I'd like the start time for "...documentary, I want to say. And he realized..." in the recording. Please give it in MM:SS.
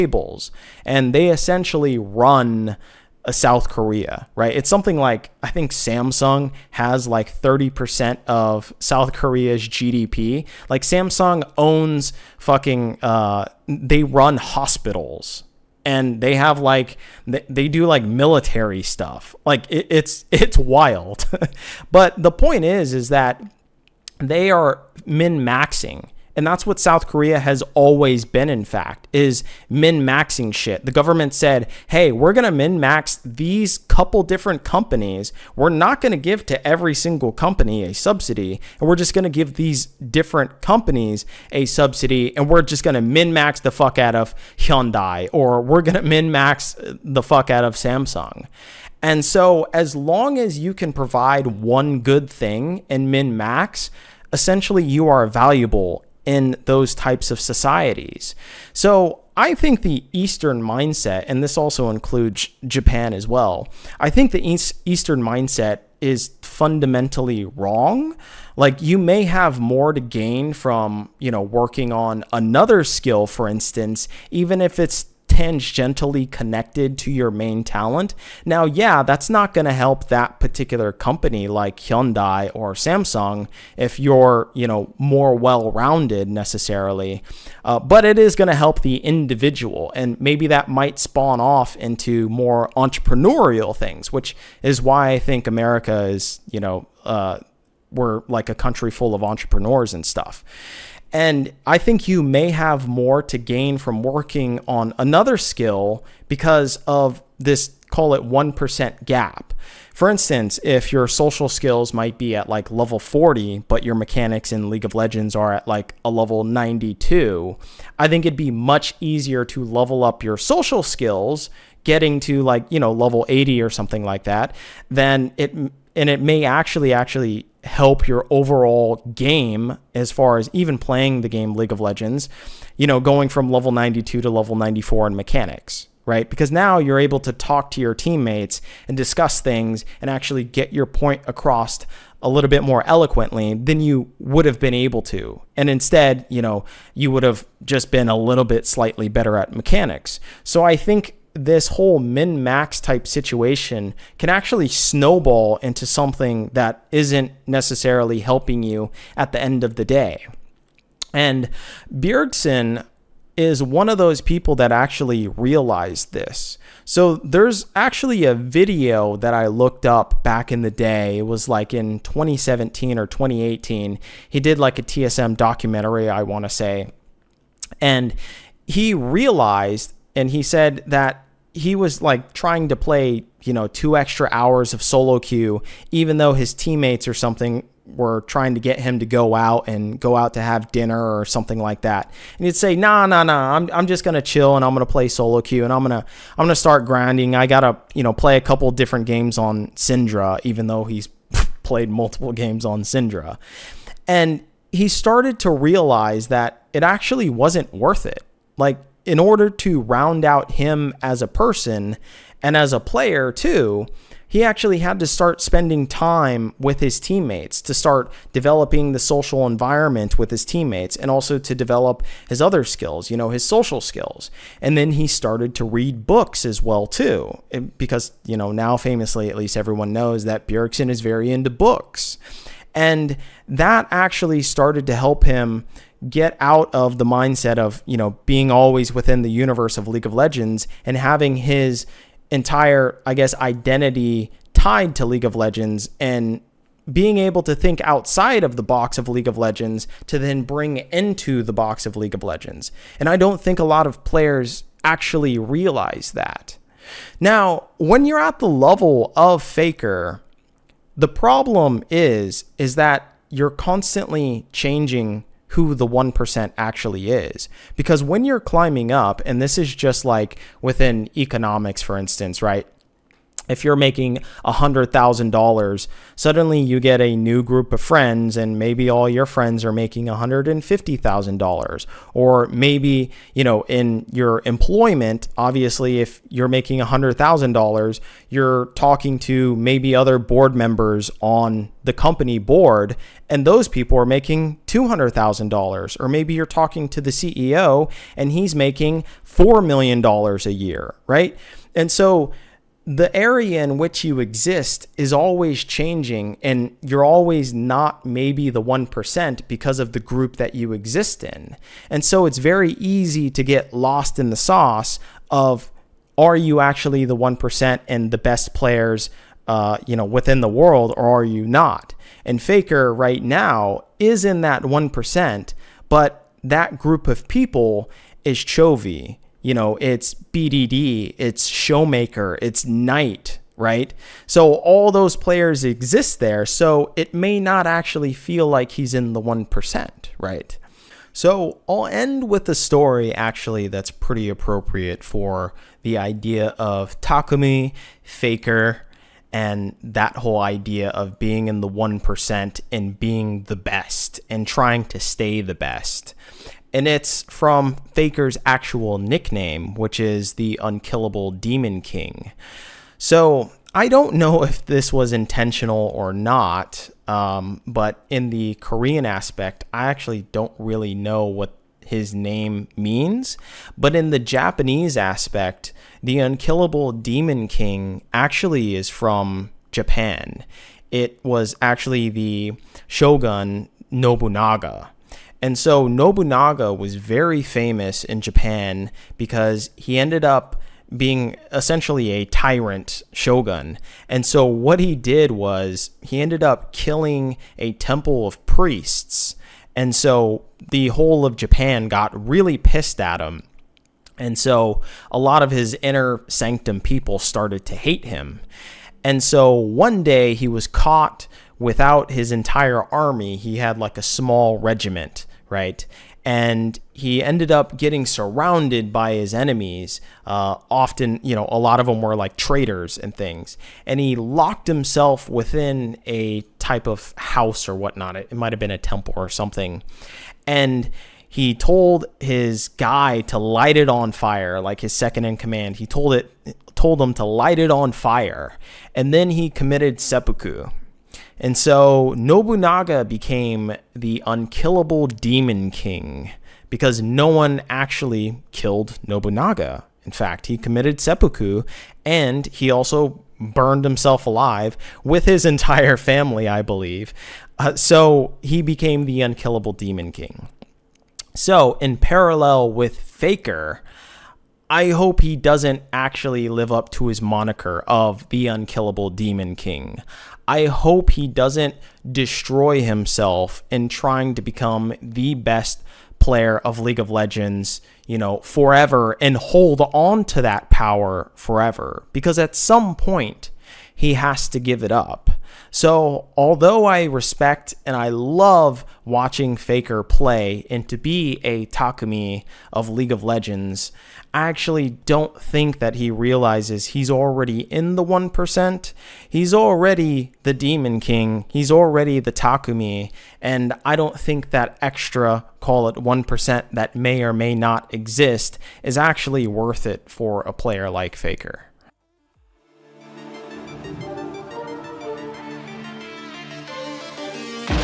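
02:55.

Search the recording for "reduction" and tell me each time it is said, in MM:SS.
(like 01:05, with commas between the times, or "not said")
not said.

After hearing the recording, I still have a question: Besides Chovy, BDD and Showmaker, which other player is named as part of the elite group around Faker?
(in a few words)
Knight.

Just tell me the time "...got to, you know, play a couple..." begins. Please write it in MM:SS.
03:17.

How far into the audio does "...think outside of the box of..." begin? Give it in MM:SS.
04:07.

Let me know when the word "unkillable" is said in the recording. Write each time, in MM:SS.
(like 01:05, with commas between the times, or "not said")
06:00, 06:16, 07:24, 07:39, 07:48.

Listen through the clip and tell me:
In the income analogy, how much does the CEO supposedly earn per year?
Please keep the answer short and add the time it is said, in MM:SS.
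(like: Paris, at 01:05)
$4 million, at 04:59.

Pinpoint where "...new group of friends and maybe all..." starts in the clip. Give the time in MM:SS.
04:37.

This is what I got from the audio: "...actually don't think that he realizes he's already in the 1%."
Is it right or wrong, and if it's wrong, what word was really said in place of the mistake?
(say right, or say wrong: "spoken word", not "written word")
right.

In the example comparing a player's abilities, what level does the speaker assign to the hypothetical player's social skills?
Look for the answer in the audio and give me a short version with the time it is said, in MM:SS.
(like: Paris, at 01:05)
40, at 01:52.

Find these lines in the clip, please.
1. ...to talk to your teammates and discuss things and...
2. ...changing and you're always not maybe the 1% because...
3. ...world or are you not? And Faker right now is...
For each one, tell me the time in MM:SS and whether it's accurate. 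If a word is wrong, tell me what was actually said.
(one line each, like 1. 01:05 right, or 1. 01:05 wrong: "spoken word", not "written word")
1. 02:17 right
2. 05:05 right
3. 05:20 right.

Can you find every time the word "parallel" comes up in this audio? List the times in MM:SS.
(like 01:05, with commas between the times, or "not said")
07:41.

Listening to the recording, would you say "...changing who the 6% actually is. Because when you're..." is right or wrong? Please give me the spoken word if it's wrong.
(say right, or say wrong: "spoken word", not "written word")
wrong: "1", not "6".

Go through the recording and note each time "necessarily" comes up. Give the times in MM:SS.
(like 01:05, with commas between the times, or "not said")
01:26, 02:37.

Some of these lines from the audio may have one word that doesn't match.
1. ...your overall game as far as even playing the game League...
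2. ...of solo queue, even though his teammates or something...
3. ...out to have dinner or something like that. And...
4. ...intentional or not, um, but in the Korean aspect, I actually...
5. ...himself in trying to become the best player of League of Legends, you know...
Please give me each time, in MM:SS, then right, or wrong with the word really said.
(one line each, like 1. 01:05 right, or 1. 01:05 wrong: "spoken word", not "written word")
1. 02:08 right
2. 03:04 right
3. 03:10 right
4. 06:05 right
5. 07:52 right.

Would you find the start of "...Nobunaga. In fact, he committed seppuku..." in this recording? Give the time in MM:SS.
07:29.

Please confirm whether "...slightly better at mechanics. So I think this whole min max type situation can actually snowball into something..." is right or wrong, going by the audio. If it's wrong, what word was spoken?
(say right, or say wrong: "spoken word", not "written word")
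right.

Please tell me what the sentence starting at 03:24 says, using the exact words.
And he started to realize that it actually wasn't worth it.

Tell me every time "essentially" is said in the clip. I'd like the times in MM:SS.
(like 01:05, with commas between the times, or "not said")
00:01, 00:54, 06:31.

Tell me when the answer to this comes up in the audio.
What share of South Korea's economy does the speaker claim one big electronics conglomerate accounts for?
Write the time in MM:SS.
00:07.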